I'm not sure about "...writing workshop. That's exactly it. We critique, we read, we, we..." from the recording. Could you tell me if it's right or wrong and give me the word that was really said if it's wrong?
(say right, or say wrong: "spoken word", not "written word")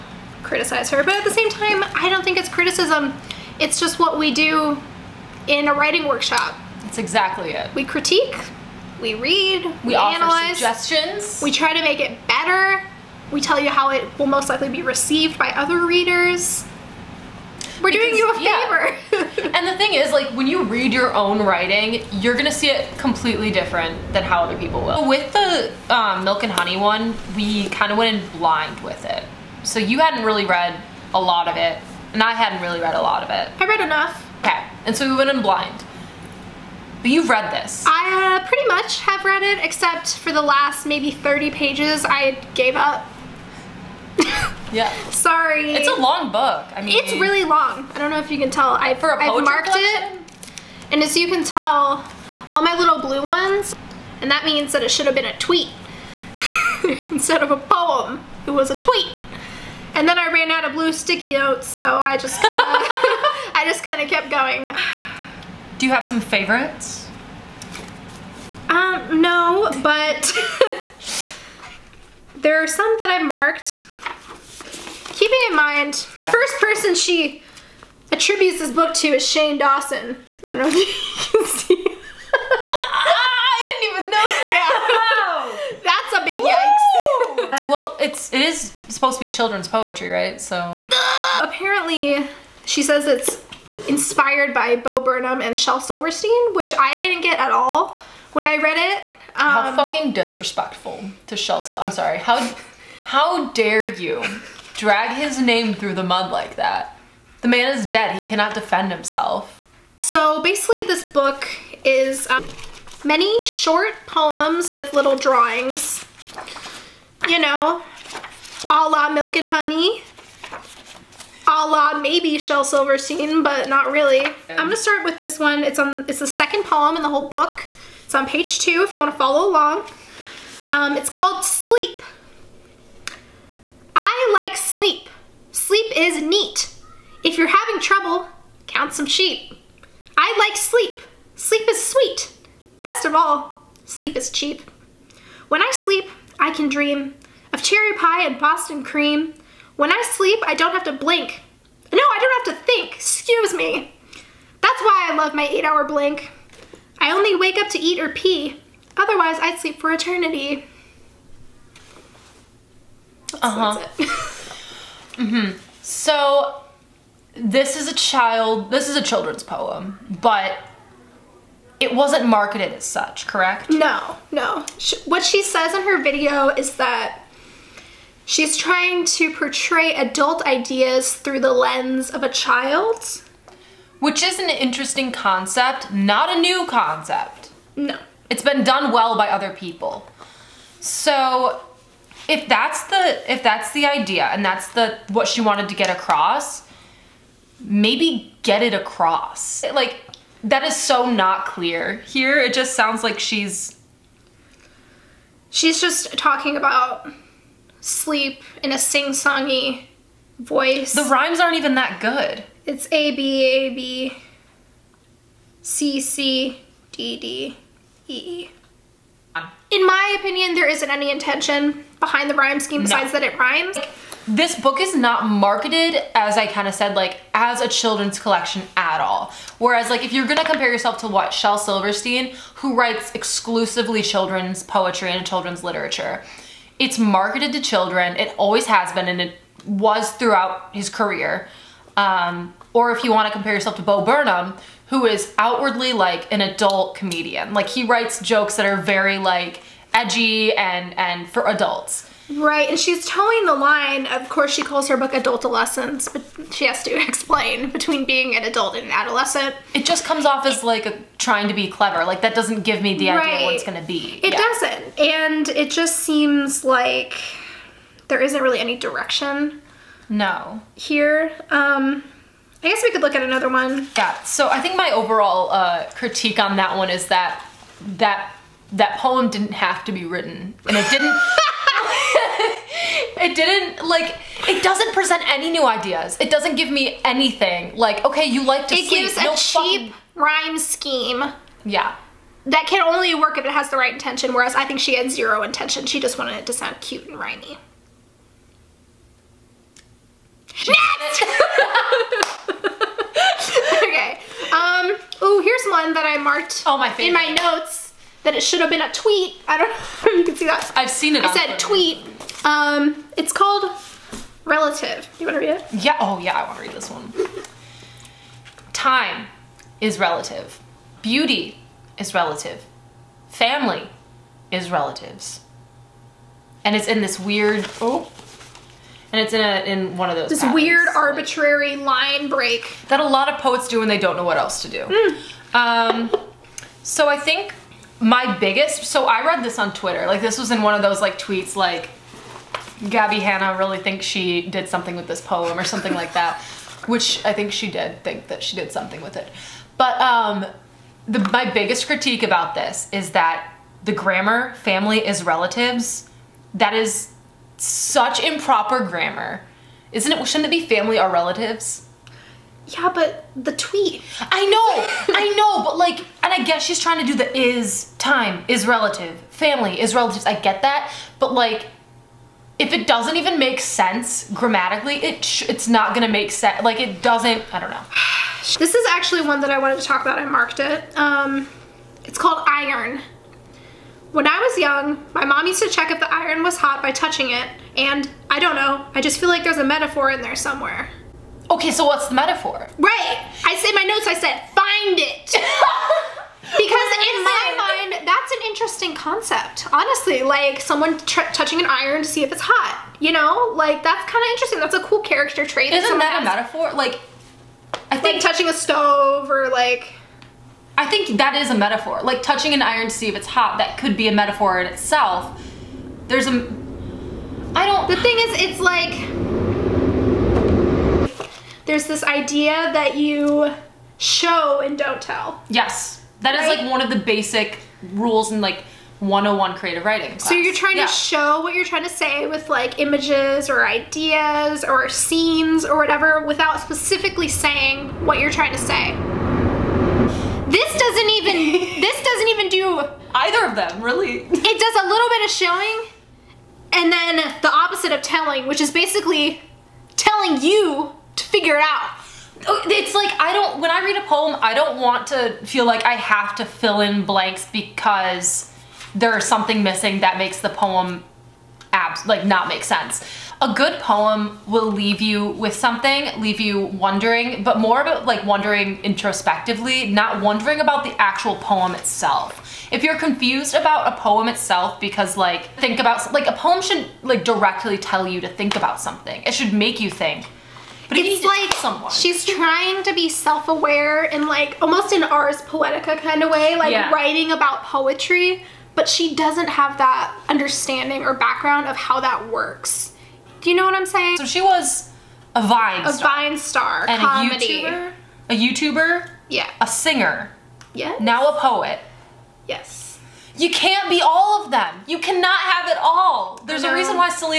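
right.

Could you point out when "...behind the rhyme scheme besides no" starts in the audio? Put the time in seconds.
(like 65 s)
221 s.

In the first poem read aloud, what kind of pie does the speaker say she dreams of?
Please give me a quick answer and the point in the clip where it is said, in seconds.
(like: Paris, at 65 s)
cherry pie, at 147 s.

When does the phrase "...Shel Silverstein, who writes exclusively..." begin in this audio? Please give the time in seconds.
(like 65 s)
231 s.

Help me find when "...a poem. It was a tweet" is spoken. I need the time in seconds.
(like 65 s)
57 s.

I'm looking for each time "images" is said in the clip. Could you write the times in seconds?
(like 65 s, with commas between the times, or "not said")
432 s.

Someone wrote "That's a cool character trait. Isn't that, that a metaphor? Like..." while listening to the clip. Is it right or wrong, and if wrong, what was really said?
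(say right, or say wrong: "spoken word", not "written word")
right.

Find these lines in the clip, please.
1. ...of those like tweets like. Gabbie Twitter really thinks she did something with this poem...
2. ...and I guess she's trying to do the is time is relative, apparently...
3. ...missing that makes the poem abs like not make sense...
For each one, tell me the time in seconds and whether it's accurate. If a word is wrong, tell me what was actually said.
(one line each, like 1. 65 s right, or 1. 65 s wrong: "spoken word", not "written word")
1. 340 s wrong: "Hanna", not "Twitter"
2. 366 s wrong: "family", not "apparently"
3. 459 s right.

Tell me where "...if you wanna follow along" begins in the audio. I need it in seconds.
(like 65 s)
128 s.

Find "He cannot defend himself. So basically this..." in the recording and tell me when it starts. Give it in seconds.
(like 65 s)
108 s.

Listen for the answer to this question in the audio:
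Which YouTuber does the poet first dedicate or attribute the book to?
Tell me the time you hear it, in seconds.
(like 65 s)
79 s.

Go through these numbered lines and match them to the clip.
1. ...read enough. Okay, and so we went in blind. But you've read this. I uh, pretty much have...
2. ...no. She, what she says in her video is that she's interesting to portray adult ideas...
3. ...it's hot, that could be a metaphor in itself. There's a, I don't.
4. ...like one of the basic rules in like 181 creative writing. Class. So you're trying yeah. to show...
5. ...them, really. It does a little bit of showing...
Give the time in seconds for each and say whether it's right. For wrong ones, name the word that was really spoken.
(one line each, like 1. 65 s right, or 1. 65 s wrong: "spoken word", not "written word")
1. 33 s right
2. 174 s wrong: "trying", not "interesting"
3. 413 s right
4. 426 s wrong: "101", not "181"
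5. 443 s right.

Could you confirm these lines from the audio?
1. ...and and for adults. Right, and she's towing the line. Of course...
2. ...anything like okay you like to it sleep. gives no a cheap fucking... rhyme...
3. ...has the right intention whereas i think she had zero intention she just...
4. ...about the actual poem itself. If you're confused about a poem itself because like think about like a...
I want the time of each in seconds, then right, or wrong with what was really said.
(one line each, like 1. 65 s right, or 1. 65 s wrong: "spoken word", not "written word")
1. 250 s right
2. 287 s right
3. 293 s right
4. 470 s right.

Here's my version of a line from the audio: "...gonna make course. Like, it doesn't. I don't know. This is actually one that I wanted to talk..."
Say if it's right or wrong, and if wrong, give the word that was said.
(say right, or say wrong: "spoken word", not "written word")
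wrong: "sense", not "course".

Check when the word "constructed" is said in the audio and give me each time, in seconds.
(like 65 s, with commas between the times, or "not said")
not said.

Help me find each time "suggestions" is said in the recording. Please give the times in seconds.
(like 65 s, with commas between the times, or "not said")
10 s.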